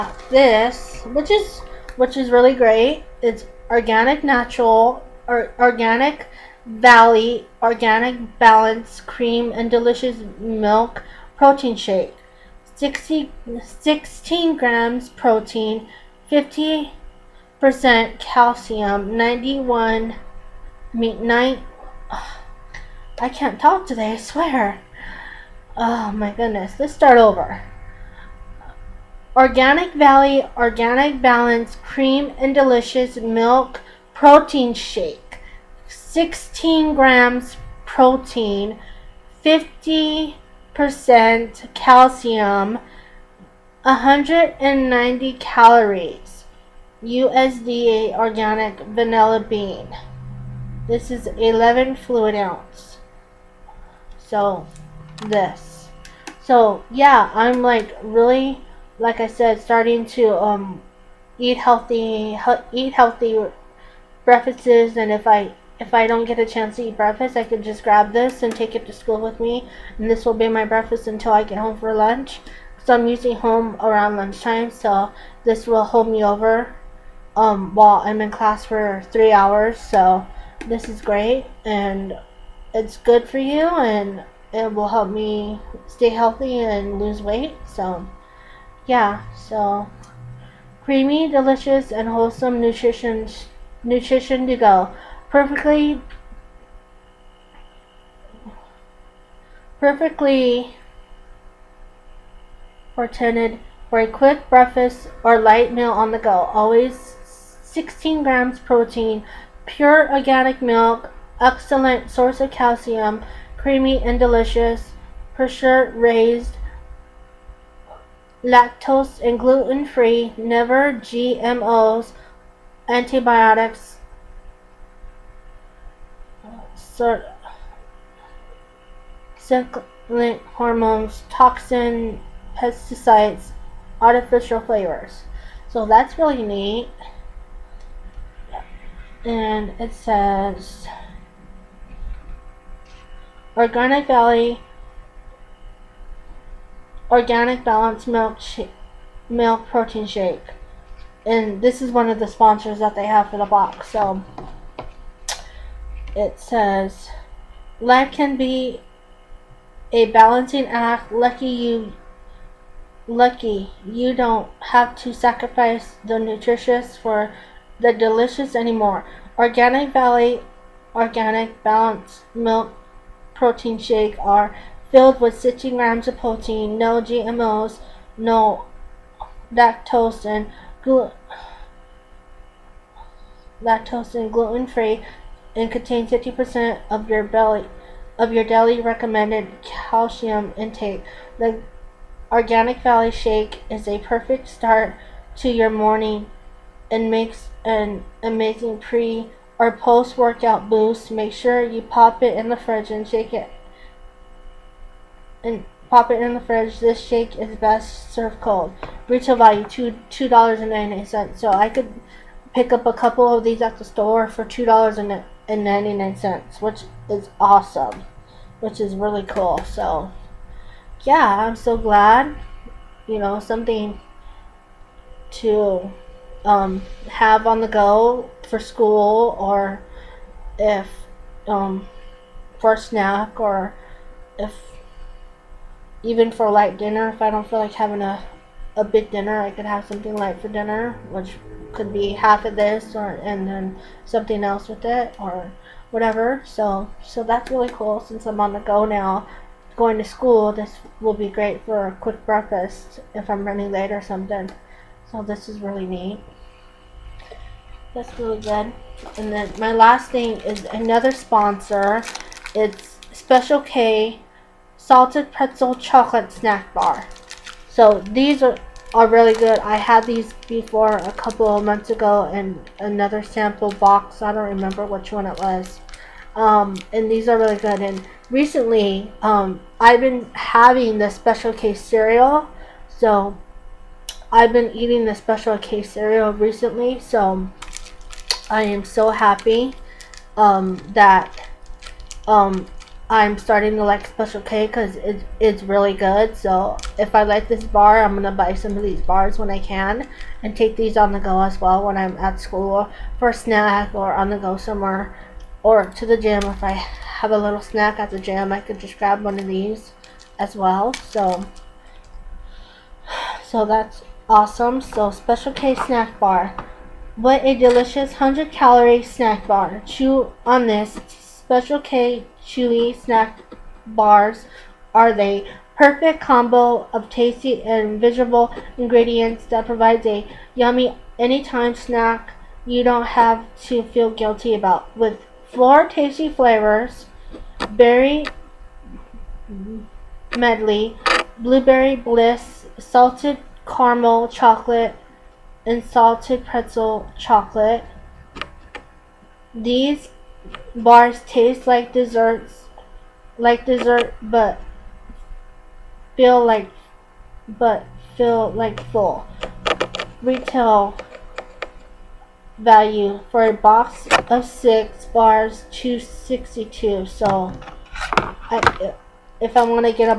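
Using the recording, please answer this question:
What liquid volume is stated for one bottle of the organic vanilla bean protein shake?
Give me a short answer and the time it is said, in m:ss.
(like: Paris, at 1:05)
11 fluid ounces, at 0:51.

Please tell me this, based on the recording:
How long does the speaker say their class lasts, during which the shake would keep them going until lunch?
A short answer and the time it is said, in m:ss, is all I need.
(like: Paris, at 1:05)
3 hours, at 1:19.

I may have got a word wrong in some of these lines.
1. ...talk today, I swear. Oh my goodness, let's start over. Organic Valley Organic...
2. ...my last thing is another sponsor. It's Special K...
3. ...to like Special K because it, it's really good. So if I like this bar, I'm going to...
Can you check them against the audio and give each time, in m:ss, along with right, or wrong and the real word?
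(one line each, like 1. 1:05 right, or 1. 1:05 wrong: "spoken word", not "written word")
1. 0:23 right
2. 4:19 right
3. 4:53 right.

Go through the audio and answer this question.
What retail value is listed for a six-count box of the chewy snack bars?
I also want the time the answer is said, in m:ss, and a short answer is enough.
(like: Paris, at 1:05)
$2.62, at 6:05.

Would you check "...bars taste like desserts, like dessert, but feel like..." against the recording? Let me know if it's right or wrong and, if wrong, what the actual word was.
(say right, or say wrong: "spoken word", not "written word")
right.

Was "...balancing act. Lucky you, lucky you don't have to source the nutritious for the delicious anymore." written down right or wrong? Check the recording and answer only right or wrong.
wrong.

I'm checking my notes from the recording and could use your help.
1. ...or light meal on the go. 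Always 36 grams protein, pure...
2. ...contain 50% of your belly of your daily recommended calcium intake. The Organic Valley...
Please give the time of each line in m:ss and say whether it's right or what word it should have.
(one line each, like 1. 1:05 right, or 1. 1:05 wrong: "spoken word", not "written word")
1. 1:45 wrong: "16", not "36"
2. 3:05 right.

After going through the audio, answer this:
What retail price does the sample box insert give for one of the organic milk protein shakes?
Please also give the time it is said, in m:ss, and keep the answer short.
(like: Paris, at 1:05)
$2.98, at 3:30.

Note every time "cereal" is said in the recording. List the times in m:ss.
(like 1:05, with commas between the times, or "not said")
4:41, 4:45.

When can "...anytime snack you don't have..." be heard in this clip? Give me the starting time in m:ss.
5:31.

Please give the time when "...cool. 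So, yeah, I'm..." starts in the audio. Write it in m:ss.
3:39.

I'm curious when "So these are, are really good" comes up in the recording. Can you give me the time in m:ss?
4:27.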